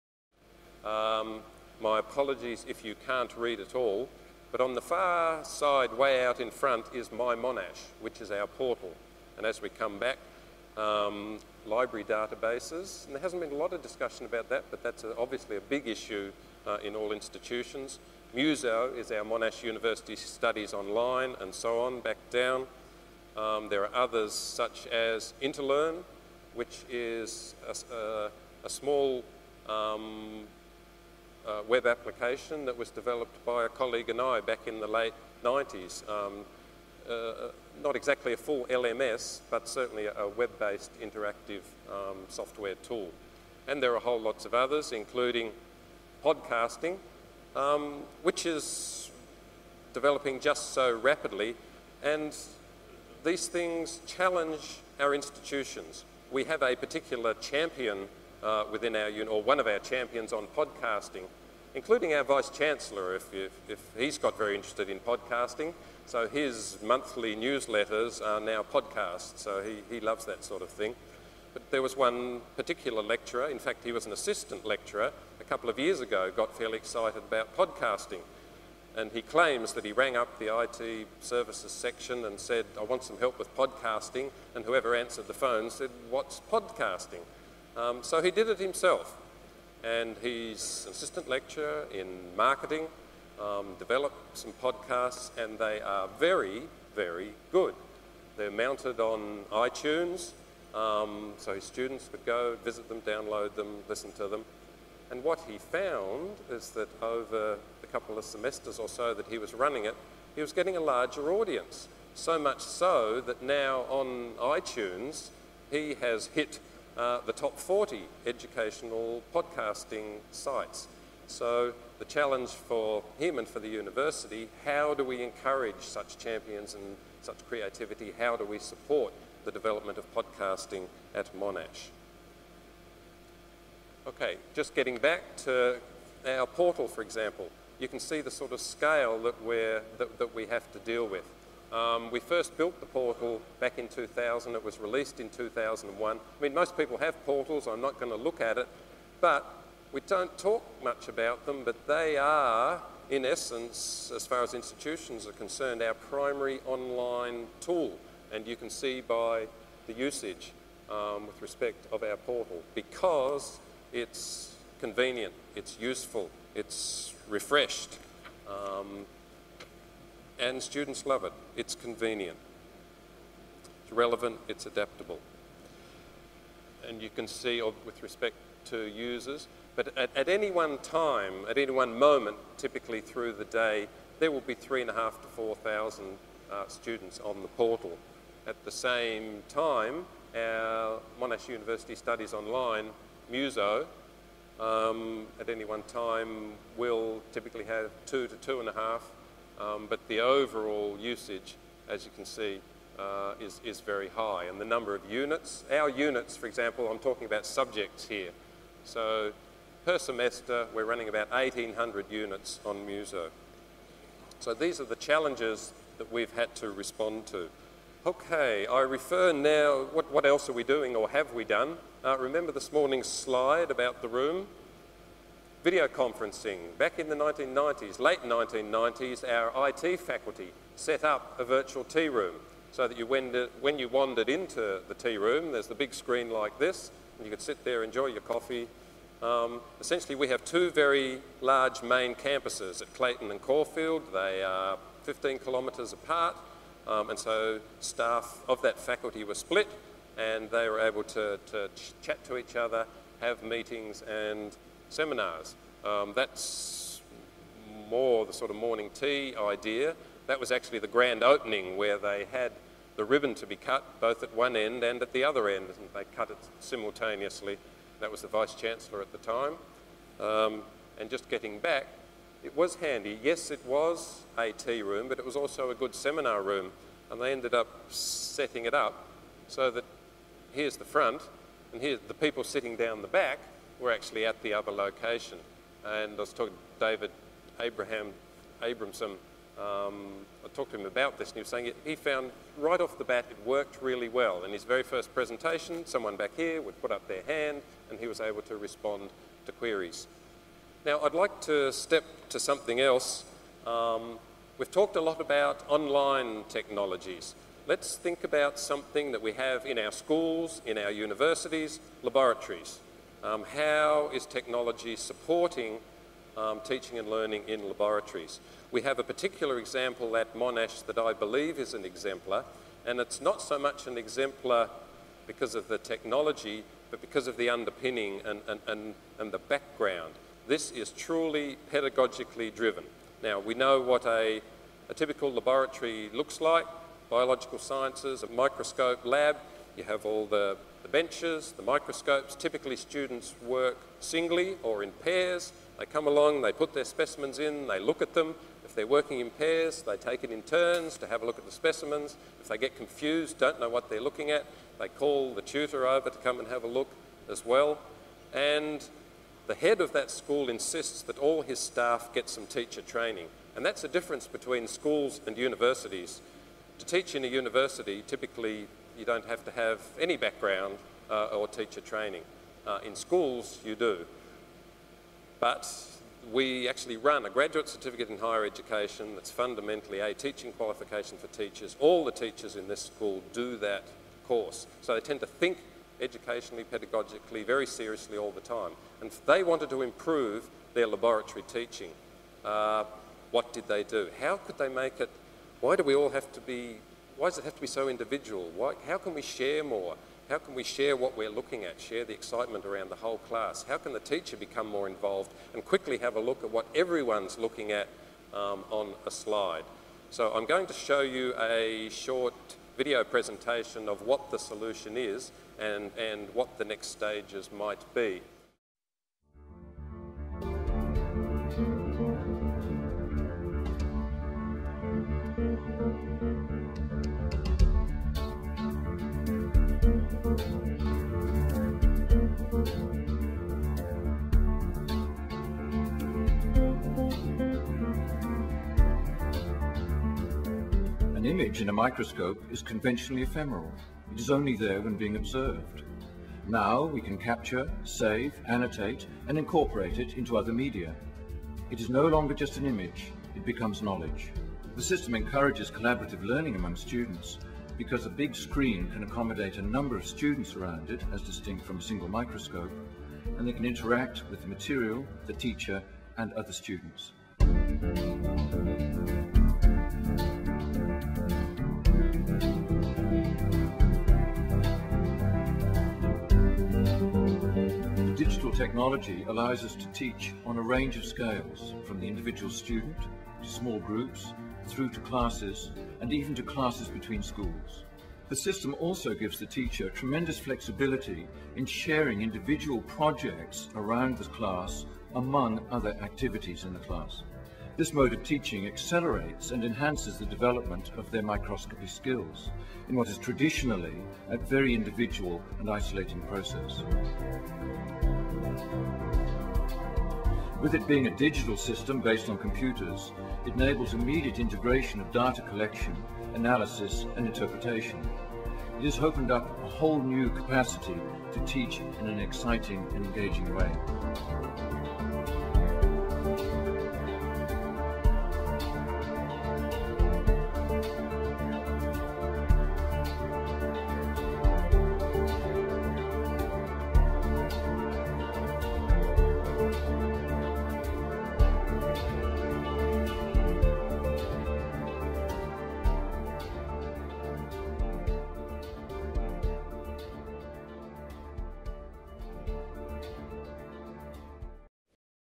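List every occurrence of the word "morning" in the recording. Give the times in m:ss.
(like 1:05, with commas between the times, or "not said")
3:42, 4:18.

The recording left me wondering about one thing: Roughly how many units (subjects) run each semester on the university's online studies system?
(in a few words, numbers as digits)
1,800.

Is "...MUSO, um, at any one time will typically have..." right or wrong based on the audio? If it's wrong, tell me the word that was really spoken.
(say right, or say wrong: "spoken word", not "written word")
right.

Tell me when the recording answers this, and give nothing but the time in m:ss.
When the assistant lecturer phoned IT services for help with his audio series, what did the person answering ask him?
1:26.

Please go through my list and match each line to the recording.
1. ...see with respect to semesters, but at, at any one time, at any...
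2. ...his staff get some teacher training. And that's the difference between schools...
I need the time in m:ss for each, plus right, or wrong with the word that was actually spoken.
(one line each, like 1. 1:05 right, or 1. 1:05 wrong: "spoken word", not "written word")
1. 2:57 wrong: "users", not "semesters"
2. 6:01 right.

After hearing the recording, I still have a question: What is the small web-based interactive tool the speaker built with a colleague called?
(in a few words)
Interlearn.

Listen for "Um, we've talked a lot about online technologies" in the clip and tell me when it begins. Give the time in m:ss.
5:03.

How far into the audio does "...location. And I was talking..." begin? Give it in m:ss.
4:44.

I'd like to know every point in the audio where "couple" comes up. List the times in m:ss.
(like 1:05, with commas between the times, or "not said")
1:15, 1:47.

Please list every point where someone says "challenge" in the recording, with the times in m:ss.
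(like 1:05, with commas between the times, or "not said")
0:54, 2:02, 3:34.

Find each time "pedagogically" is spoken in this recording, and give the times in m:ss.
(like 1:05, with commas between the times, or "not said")
5:31, 6:26.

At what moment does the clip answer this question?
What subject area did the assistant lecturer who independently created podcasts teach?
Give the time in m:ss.
1:32.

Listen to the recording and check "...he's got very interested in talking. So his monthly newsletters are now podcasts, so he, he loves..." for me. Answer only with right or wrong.
wrong.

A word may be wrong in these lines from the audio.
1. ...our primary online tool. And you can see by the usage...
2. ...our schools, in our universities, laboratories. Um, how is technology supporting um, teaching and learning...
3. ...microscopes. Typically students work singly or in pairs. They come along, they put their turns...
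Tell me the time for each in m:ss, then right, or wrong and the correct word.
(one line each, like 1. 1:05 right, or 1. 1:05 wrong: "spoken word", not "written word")
1. 2:35 right
2. 5:09 right
3. 5:41 wrong: "specimens", not "turns".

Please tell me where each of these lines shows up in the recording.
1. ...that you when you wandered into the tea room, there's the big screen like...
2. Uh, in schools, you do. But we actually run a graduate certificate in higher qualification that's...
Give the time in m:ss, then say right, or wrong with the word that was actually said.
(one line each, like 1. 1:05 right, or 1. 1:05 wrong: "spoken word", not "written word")
1. 3:52 right
2. 6:12 wrong: "education", not "qualification".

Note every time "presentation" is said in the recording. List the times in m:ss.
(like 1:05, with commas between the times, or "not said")
4:55, 6:53.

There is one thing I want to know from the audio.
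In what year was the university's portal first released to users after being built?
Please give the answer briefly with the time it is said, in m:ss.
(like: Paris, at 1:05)
2001, at 2:25.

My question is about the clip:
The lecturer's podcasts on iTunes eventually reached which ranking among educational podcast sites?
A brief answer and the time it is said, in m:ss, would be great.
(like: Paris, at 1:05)
Top 40, at 1:57.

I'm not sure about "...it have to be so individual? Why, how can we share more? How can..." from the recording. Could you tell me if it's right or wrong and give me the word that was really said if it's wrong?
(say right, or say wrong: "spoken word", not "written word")
right.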